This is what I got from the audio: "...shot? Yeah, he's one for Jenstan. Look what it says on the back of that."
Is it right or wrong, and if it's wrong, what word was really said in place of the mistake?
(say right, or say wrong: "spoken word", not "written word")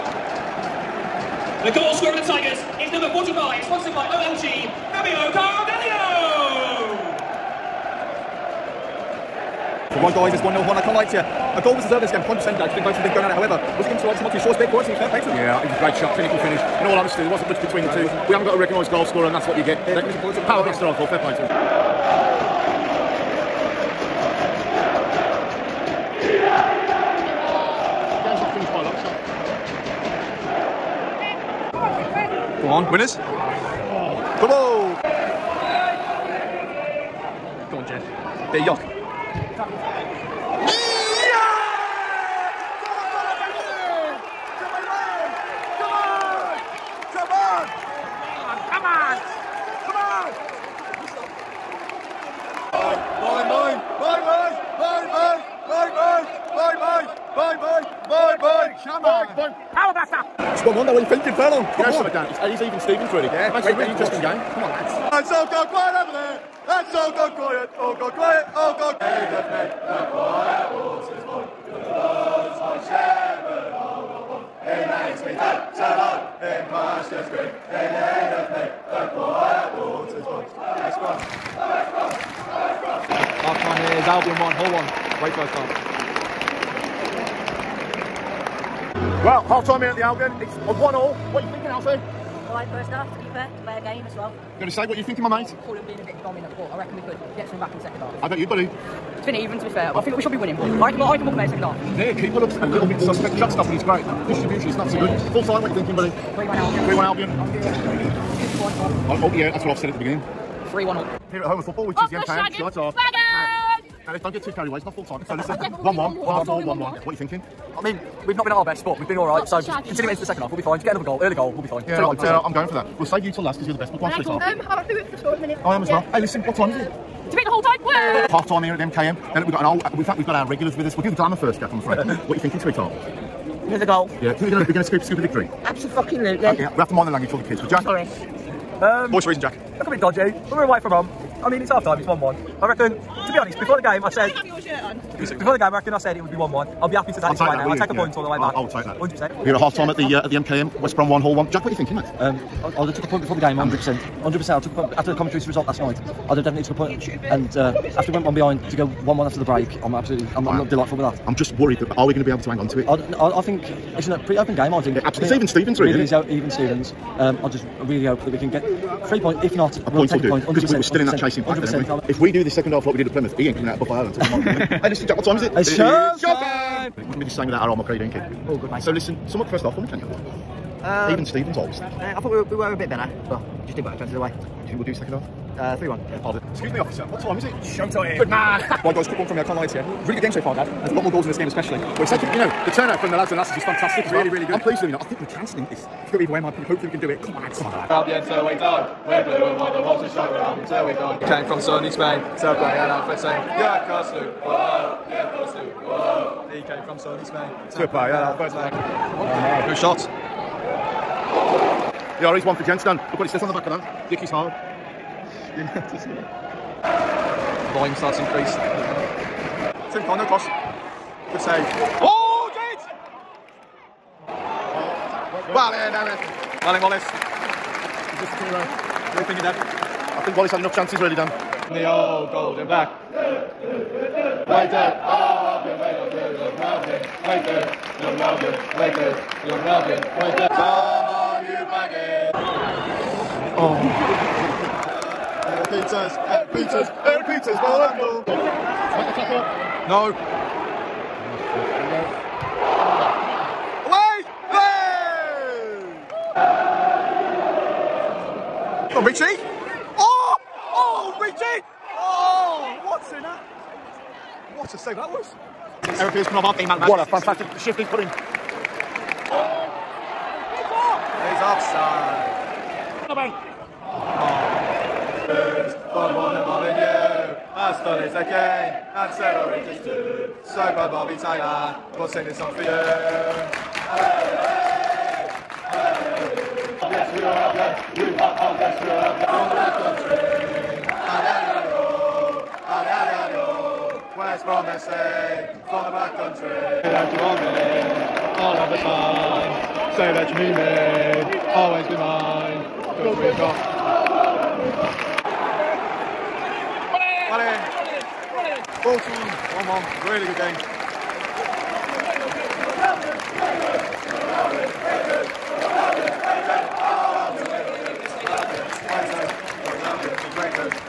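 right.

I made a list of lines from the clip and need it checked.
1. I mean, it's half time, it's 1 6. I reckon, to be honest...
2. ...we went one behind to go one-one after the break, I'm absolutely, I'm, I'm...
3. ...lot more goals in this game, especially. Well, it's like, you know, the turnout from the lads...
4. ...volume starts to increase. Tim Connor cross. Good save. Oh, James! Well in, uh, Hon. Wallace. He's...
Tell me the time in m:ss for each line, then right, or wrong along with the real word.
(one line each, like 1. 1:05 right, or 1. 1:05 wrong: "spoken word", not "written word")
1. 2:21 wrong: "1", not "6"
2. 2:38 right
3. 3:10 right
4. 3:37 wrong: "Eric", not "Hon".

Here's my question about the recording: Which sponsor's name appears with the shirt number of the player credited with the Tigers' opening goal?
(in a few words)
OLG.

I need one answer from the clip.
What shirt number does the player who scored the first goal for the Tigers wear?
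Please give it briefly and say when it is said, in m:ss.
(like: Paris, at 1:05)
45, at 0:02.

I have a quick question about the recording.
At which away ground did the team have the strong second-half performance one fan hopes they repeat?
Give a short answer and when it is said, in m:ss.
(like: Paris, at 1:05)
Plymouth, at 2:53.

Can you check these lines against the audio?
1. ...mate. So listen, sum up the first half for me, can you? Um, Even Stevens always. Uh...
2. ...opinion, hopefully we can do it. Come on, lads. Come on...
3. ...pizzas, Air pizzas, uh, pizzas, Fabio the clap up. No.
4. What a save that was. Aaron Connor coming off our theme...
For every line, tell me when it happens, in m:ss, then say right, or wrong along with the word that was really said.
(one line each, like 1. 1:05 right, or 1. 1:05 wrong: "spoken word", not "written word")
1. 2:58 right
2. 3:16 right
3. 4:05 wrong: "Make", not "Fabio"
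4. 4:22 wrong: "Pierce", not "Connor".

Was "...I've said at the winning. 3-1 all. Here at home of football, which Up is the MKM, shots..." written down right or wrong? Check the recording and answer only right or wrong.
wrong.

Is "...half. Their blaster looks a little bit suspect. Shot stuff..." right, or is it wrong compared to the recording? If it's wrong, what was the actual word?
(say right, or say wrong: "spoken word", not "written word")
wrong: "keeper", not "blaster".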